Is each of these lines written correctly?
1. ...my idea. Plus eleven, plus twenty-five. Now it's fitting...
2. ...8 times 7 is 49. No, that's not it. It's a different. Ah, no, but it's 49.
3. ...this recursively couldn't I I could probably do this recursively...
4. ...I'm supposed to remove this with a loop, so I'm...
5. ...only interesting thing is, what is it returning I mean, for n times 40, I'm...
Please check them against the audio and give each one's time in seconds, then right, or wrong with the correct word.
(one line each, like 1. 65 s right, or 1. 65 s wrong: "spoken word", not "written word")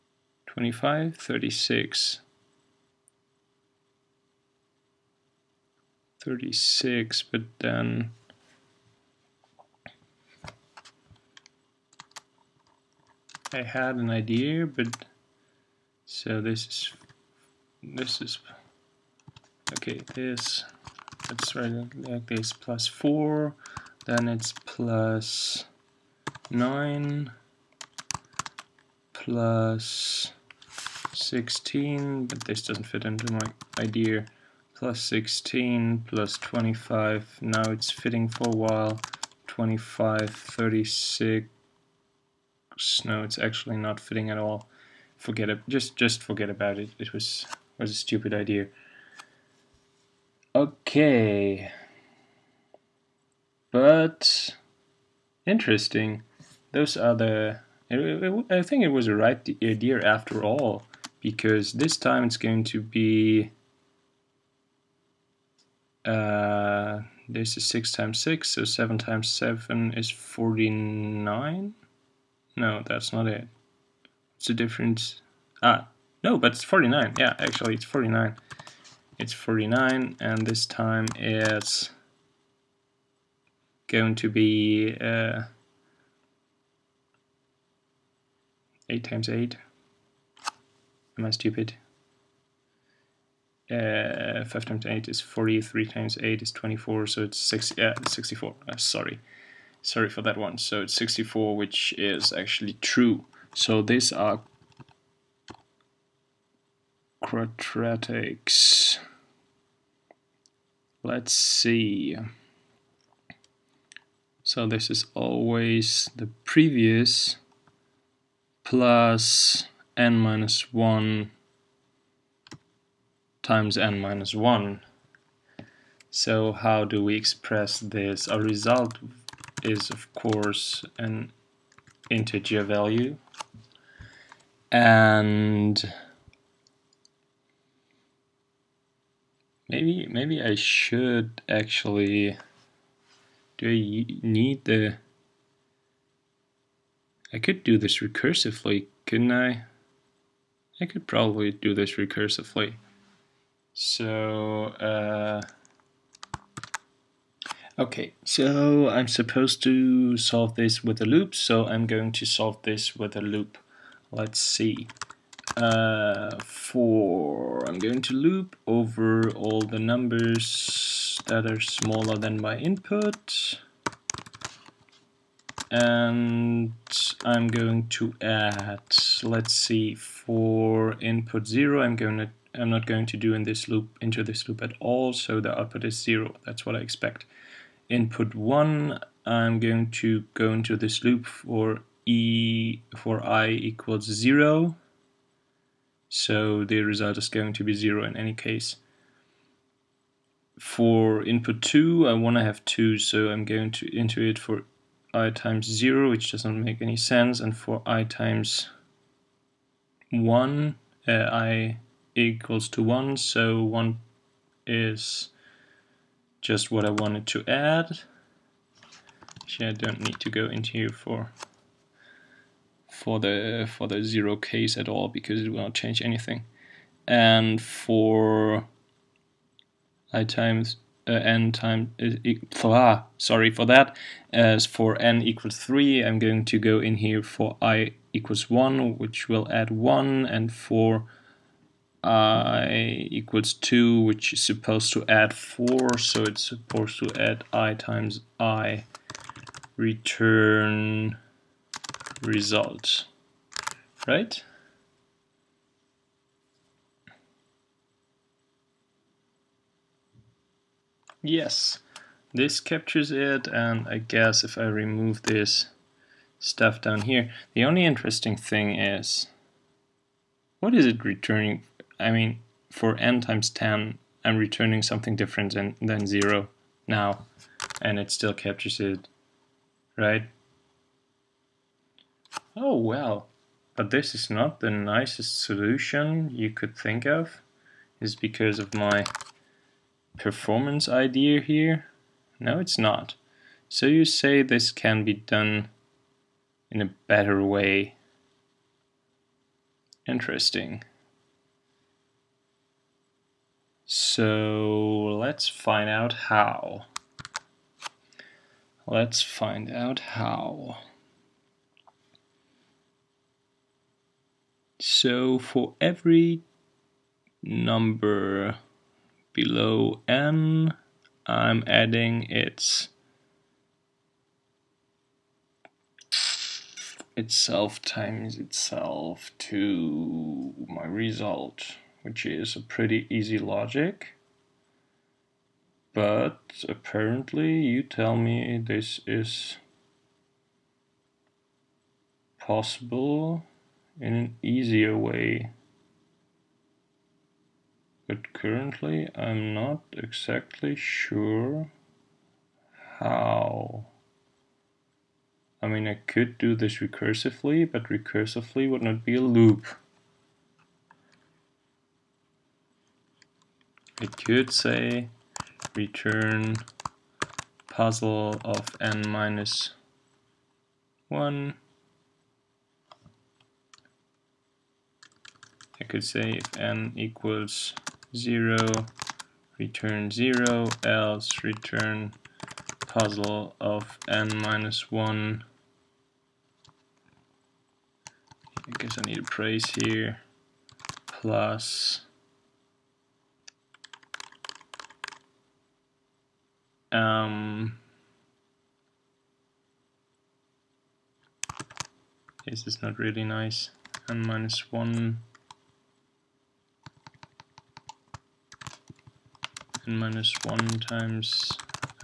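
1. 33 s wrong: "sixteen", not "eleven"
2. 68 s wrong: "7", not "8"
3. 147 s right
4. 158 s wrong: "solve", not "remove"
5. 267 s wrong: "10", not "40".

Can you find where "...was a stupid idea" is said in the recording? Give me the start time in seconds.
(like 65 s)
47 s.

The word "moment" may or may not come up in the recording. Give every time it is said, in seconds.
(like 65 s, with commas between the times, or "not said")
not said.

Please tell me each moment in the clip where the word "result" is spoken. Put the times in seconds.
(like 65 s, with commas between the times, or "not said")
128 s, 196 s, 252 s, 330 s.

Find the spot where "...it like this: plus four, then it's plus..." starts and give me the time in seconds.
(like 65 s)
21 s.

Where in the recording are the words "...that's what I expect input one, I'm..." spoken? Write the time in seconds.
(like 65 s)
186 s.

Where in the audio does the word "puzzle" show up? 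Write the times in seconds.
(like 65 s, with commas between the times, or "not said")
367 s, 382 s.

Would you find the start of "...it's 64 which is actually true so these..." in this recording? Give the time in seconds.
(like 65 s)
100 s.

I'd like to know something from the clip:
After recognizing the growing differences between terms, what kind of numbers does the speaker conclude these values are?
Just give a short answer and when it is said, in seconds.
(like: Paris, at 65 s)
quadratics, at 107 s.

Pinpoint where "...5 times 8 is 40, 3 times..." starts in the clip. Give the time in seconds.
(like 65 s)
94 s.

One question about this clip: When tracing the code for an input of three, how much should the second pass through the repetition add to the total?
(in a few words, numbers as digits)
4.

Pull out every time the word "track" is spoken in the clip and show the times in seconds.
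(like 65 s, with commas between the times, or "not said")
not said.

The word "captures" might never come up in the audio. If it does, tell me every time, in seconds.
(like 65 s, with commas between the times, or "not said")
262 s, 278 s.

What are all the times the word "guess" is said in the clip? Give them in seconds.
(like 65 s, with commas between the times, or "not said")
263 s, 388 s.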